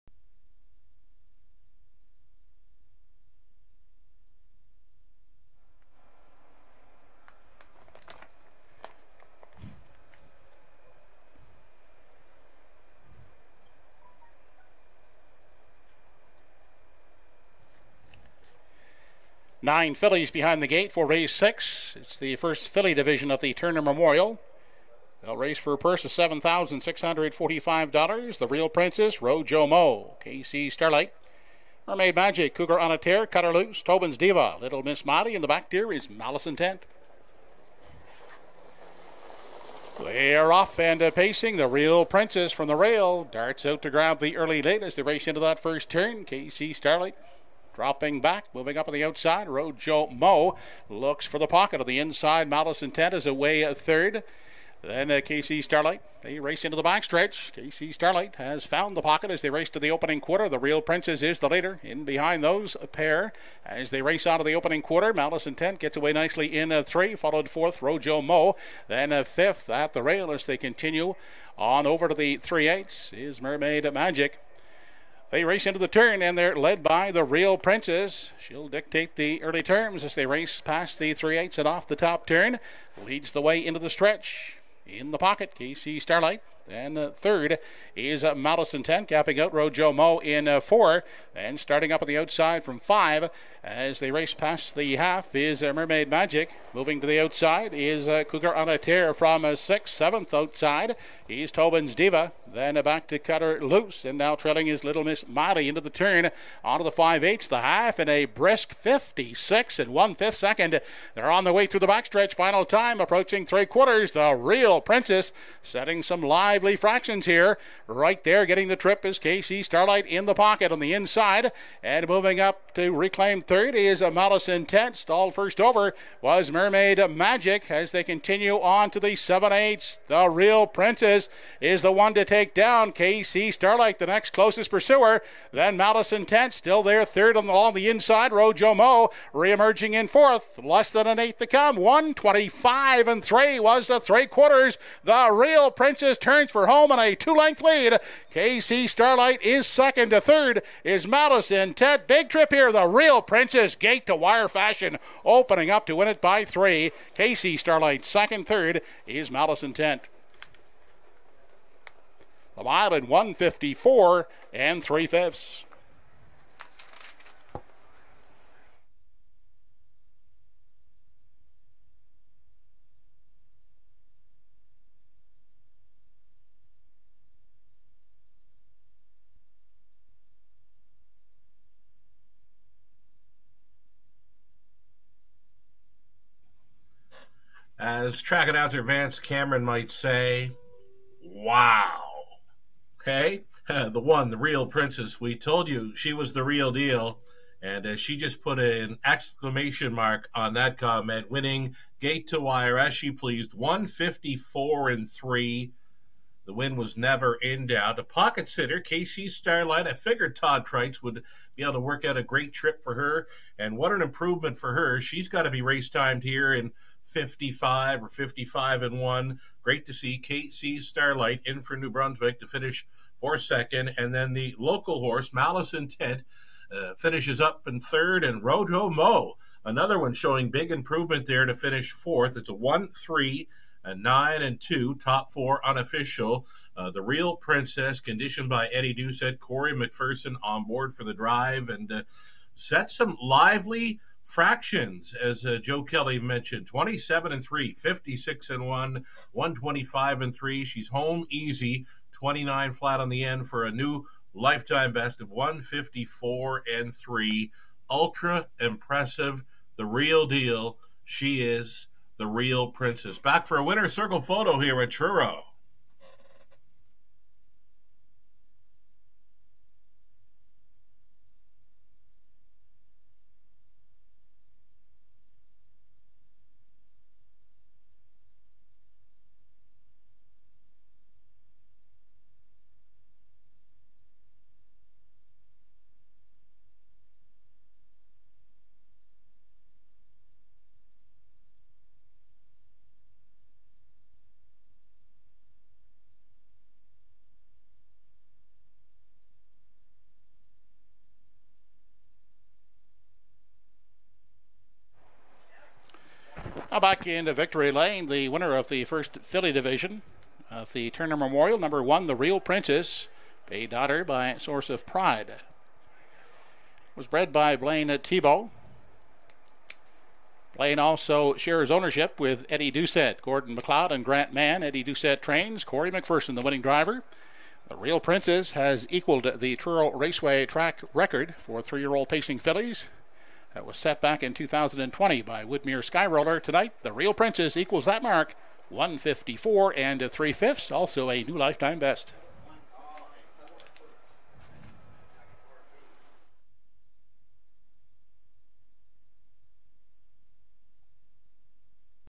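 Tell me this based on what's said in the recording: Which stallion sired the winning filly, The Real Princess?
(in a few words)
Source of Pride.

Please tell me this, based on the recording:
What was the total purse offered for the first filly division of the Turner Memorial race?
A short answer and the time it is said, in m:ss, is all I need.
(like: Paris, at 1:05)
$7,645, at 0:26.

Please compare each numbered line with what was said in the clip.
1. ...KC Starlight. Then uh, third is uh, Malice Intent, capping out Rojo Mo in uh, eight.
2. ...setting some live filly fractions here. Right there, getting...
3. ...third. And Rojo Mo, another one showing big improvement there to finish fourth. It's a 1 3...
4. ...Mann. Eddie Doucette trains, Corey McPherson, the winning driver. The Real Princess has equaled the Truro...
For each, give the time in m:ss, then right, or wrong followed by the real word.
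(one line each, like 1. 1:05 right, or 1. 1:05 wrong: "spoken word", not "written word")
1. 1:25 wrong: "four", not "eight"
2. 1:55 wrong: "lively", not "filly"
3. 3:47 right
4. 5:24 right.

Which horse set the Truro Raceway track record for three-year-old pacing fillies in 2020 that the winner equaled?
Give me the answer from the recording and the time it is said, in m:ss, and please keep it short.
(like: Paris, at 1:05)
Whitmere Skyroller, at 5:35.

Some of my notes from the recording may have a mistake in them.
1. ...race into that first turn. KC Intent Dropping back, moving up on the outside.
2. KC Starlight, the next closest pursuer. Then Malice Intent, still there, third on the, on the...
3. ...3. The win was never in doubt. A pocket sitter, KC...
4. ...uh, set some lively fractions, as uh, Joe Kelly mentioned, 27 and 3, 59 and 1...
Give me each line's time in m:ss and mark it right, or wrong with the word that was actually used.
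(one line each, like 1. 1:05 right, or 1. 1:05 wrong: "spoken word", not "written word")
1. 0:45 wrong: "Starlight", not "Intent"
2. 2:12 right
3. 3:25 right
4. 4:01 wrong: "56", not "59".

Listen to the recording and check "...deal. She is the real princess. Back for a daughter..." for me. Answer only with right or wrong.
wrong.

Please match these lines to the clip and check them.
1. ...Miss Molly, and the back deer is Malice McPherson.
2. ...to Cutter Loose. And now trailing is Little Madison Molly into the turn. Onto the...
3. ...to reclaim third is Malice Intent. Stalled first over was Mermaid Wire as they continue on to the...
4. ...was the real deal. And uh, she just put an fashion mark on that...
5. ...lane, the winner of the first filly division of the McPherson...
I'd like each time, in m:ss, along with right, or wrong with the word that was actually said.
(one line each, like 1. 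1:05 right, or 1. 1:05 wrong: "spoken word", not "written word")
1. 0:34 wrong: "Intent", not "McPherson"
2. 1:43 wrong: "Miss", not "Madison"
3. 2:02 wrong: "Magic", not "Wire"
4. 3:16 wrong: "exclamation", not "fashion"
5. 5:07 wrong: "Turner", not "McPherson".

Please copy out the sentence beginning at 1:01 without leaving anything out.
In behind those pair as they race out of the opening quarter.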